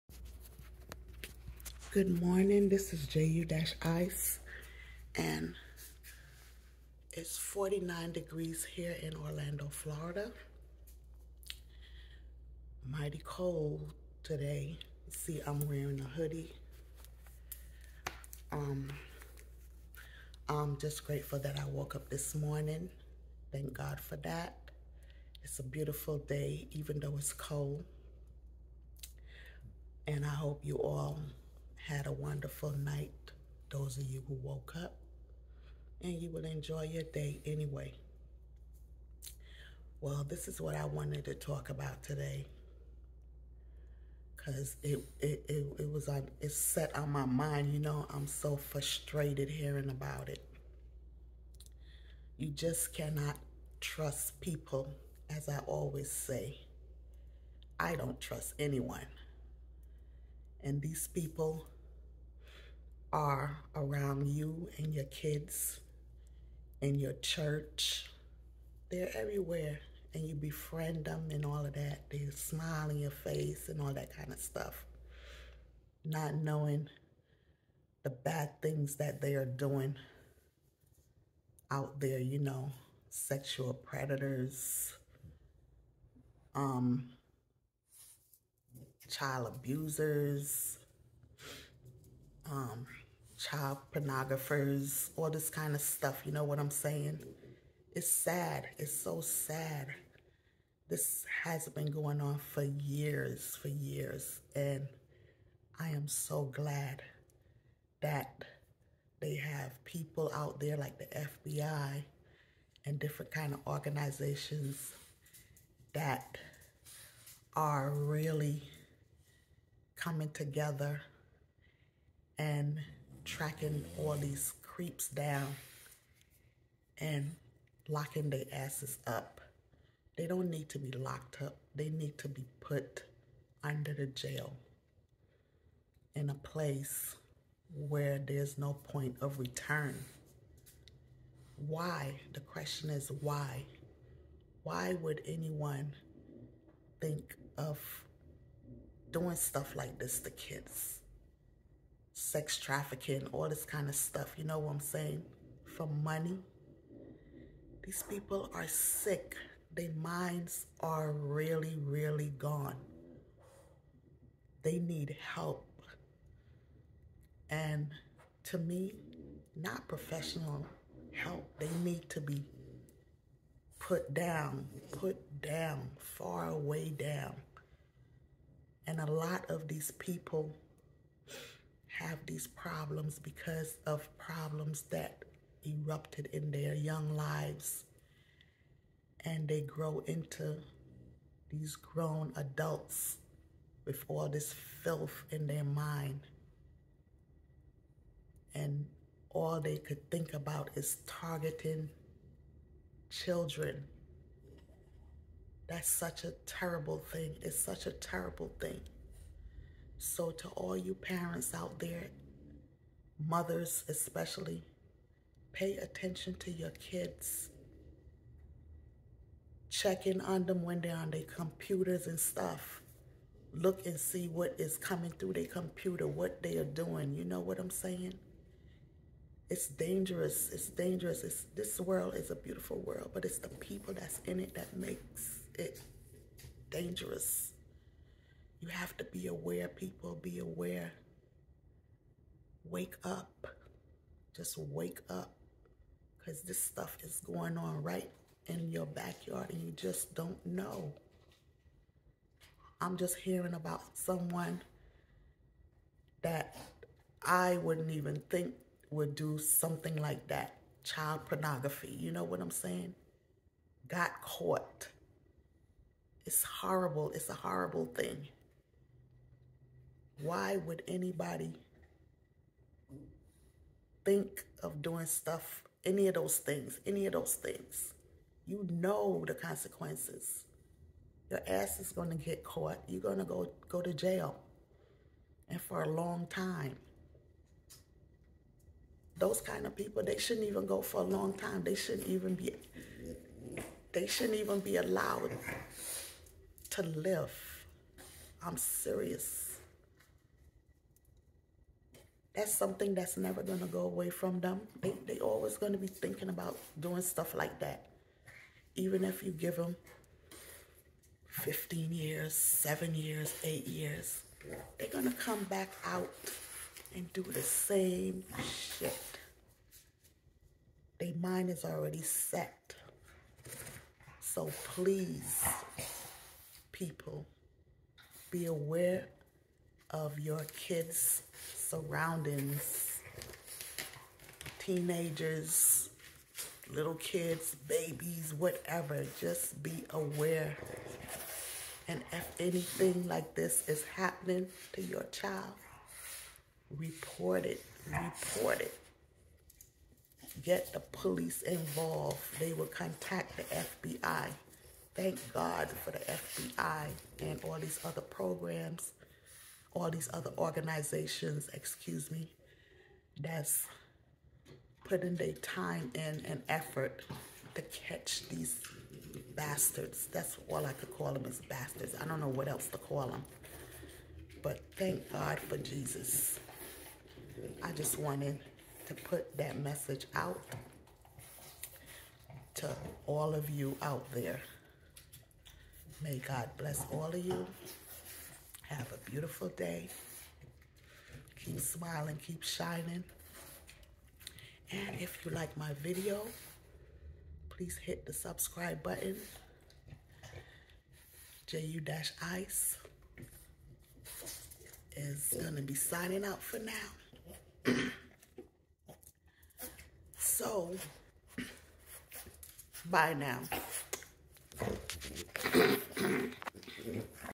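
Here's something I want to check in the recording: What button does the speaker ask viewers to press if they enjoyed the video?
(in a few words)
Subscribe.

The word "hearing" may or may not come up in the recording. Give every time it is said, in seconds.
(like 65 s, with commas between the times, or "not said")
49 s, 253 s.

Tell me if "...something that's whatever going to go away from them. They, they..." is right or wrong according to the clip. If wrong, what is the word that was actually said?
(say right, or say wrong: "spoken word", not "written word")
wrong: "never", not "whatever".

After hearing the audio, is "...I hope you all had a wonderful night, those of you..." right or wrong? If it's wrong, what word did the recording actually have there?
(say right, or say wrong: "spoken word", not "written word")
right.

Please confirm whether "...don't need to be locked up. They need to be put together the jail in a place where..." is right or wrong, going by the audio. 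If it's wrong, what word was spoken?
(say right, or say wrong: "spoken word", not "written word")
wrong: "under", not "together".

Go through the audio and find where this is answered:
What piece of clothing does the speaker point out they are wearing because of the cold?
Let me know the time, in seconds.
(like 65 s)
16 s.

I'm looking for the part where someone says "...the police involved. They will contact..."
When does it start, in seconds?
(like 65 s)
350 s.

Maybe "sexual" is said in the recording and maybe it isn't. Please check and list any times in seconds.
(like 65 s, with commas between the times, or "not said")
83 s.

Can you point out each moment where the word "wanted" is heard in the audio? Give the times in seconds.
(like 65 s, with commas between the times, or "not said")
40 s, 377 s.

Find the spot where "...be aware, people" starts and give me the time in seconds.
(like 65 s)
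239 s.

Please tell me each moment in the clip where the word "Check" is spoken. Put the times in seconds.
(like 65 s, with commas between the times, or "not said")
219 s.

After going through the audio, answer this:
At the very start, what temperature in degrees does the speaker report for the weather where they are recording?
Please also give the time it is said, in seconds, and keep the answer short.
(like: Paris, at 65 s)
49, at 7 s.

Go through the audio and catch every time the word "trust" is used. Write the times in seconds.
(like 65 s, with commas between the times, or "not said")
53 s, 58 s.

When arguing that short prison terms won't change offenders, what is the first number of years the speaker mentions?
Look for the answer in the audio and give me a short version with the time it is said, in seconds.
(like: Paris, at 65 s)
15, at 311 s.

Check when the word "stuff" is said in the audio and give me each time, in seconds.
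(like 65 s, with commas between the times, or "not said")
74 s, 95 s, 149 s, 153 s, 222 s, 246 s, 275 s, 307 s.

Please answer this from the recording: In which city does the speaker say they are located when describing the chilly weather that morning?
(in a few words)
Orlando.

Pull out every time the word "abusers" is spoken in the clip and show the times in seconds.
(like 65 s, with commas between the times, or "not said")
89 s.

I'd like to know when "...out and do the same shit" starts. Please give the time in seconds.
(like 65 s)
315 s.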